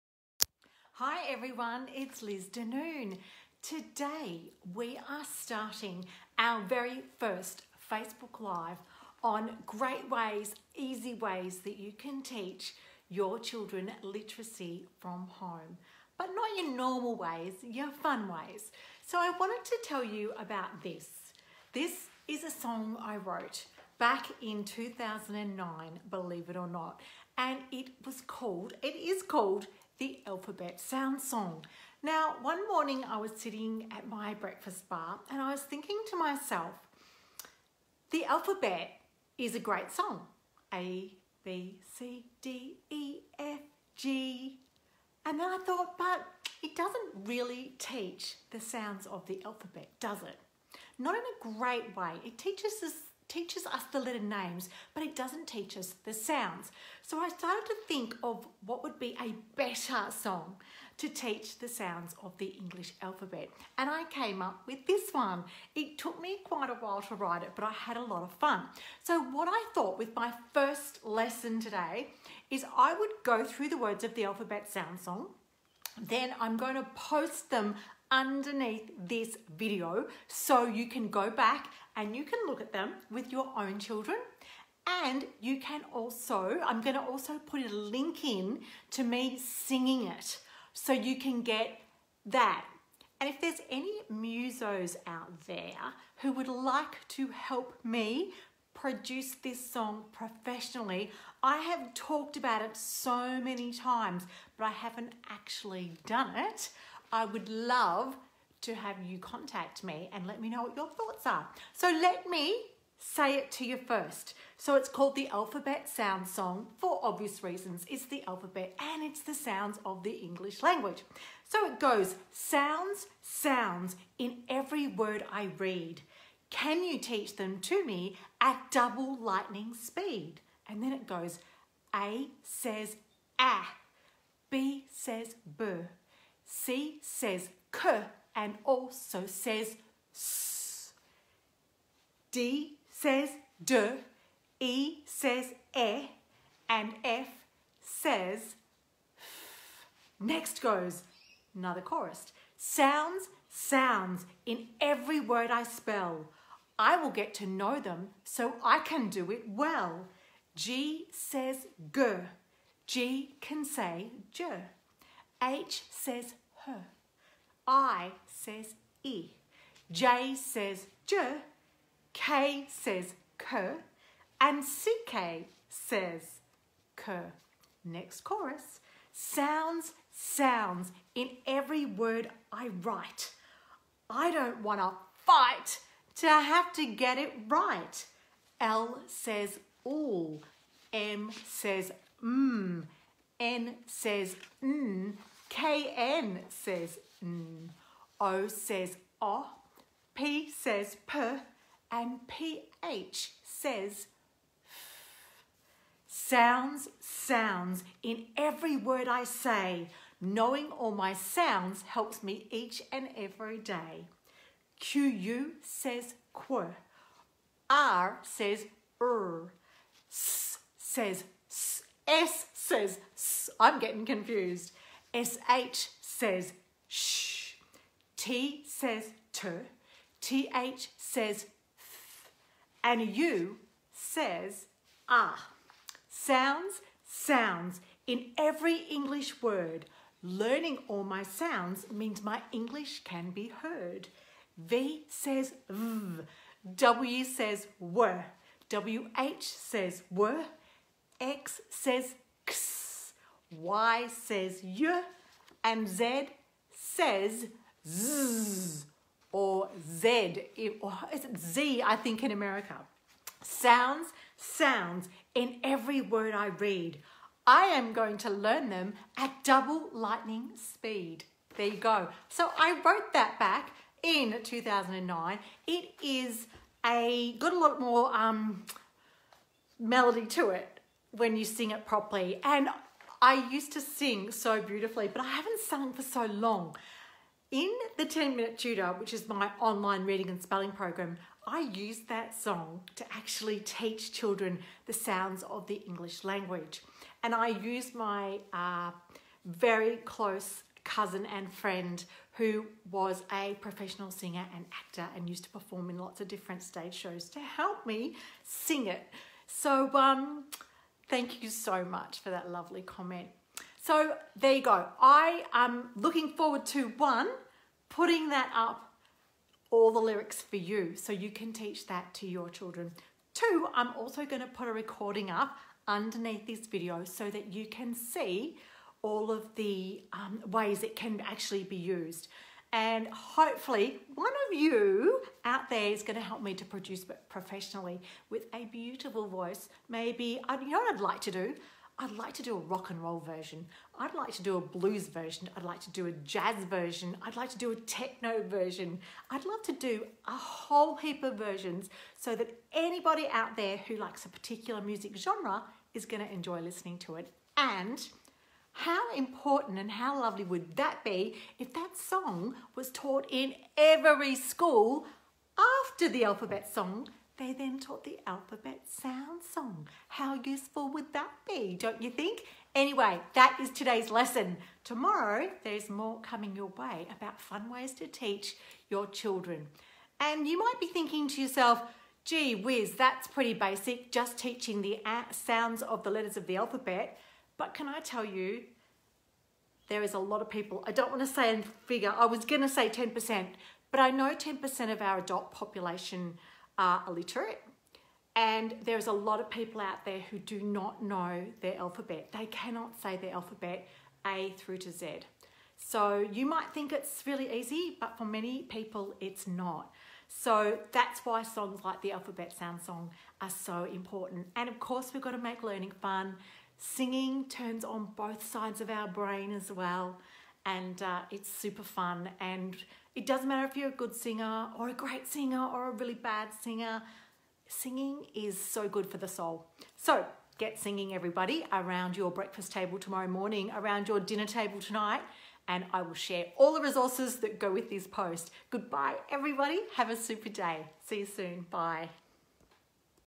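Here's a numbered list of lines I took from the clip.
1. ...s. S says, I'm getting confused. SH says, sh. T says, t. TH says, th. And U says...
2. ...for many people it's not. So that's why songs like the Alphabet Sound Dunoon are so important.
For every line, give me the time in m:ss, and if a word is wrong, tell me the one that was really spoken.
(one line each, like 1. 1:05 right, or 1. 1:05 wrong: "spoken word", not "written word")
1. 3:41 right
2. 6:48 wrong: "Song", not "Dunoon".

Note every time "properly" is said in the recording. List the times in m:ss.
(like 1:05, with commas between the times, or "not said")
4:41.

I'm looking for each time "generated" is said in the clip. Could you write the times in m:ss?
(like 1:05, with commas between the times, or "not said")
not said.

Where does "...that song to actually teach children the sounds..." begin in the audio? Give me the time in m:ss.
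4:52.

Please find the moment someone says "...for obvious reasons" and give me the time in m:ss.
1:56.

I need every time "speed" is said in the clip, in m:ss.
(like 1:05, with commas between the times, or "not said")
2:09, 4:30.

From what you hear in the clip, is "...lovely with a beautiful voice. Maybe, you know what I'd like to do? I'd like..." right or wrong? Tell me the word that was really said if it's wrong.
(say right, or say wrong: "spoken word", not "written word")
wrong: "professionally", not "lovely".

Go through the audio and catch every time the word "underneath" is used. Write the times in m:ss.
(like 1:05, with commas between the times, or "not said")
1:18, 5:25.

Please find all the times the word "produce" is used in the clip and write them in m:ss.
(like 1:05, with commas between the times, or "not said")
1:38, 5:36.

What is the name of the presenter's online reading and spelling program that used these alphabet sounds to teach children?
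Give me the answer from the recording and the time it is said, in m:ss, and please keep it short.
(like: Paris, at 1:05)
10 Minute Tutor, at 4:48.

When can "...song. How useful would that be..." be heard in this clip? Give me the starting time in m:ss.
6:09.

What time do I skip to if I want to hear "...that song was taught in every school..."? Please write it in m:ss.
6:01.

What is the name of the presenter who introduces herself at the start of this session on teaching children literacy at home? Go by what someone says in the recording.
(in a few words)
Liz Dunoon.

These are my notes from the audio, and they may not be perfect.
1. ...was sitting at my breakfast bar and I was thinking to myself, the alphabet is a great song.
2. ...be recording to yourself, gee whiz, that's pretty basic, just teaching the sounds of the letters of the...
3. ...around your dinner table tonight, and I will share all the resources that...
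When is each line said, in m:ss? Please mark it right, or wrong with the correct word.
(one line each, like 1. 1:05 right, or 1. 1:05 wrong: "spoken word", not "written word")
1. 0:33 right
2. 6:20 wrong: "thinking", not "recording"
3. 7:13 right.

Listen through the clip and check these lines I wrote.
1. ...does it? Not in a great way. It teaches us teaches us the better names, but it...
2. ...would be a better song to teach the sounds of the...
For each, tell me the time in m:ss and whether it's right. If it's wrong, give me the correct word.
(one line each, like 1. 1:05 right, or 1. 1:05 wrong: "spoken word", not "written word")
1. 0:49 wrong: "letter", not "better"
2. 0:58 right.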